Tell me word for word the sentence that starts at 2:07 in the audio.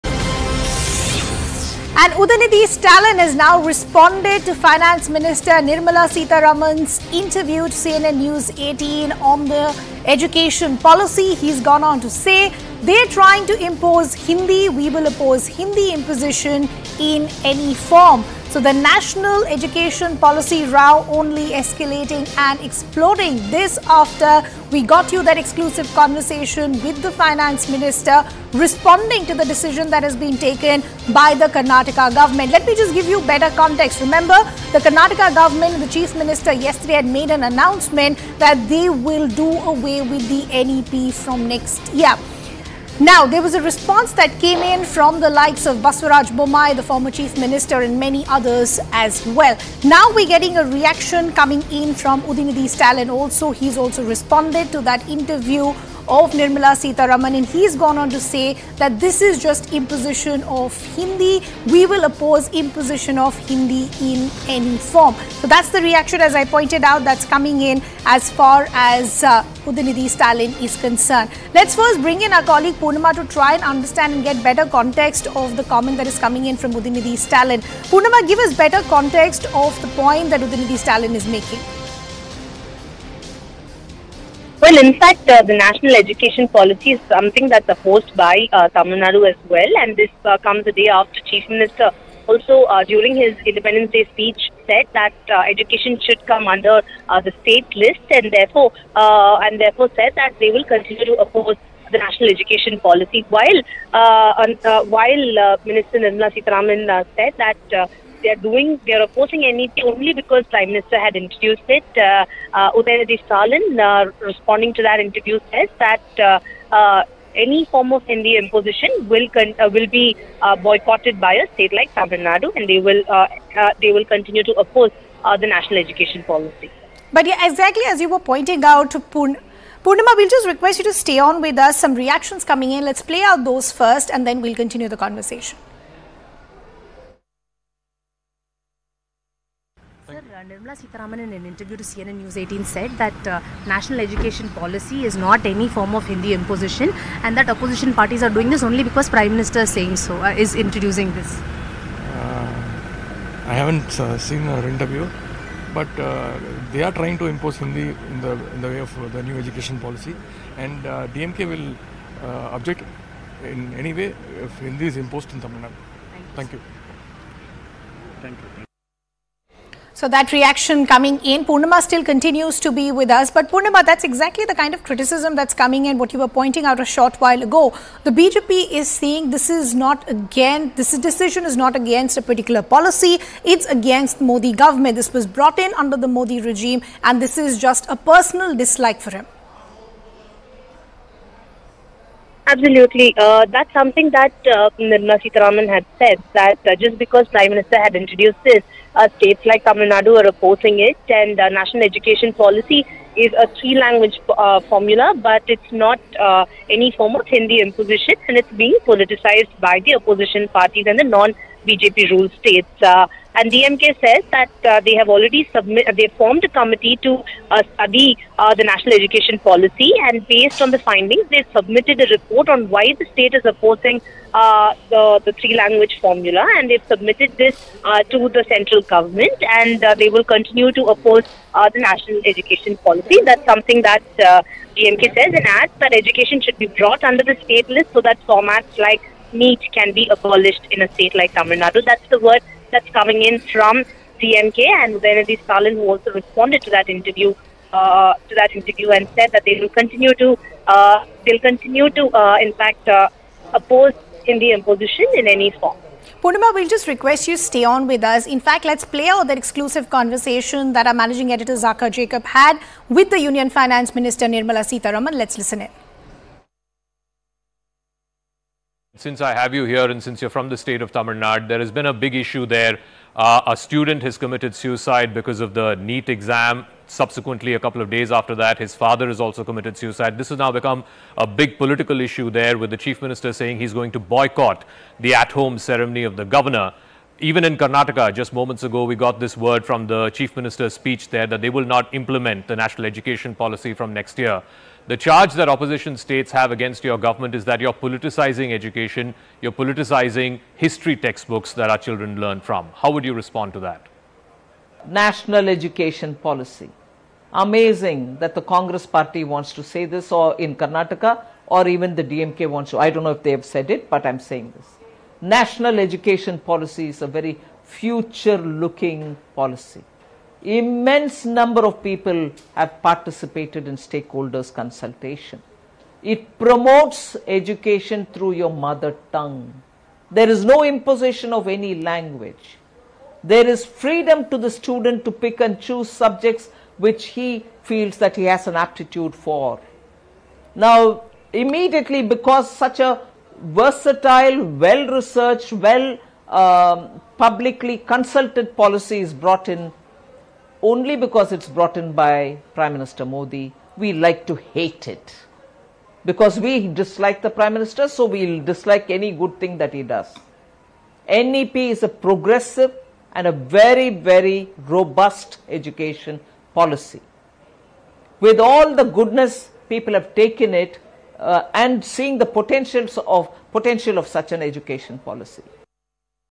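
But yeah, exactly as you were pointing out, Pun- Purnima, we'll just request you to stay on with us.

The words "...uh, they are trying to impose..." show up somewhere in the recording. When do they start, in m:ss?
2:35.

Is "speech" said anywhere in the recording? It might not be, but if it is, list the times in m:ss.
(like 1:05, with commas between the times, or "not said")
1:34, 4:50.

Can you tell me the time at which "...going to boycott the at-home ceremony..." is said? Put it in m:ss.
4:43.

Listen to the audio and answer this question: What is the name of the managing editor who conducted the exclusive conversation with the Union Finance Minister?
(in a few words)
Zakka Jacob.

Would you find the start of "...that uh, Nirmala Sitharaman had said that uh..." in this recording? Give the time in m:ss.
3:14.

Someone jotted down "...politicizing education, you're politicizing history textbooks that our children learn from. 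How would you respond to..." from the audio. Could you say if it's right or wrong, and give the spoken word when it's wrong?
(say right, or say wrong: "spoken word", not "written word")
right.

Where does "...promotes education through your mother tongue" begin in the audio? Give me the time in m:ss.
5:26.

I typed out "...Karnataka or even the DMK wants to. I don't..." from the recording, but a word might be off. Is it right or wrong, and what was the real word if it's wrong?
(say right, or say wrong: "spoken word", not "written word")
right.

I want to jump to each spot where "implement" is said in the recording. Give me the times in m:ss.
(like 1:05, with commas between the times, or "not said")
4:51.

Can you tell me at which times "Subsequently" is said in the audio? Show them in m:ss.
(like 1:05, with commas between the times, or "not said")
4:36.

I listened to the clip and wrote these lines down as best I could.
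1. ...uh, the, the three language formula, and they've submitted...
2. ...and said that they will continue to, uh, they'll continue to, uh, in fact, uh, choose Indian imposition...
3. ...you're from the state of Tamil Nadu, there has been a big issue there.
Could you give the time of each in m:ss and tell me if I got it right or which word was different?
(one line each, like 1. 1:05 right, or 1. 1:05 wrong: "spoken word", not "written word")
1. 3:44 right
2. 4:08 wrong: "oppose", not "choose"
3. 4:30 right.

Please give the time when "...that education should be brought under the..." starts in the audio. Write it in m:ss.
3:55.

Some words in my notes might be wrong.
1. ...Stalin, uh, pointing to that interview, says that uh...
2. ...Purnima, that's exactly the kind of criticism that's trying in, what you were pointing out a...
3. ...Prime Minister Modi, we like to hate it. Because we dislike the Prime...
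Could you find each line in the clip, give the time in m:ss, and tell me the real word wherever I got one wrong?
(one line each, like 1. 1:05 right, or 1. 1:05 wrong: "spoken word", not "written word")
1. 1:53 wrong: "responding", not "pointing"
2. 2:53 wrong: "coming", not "trying"
3. 5:52 right.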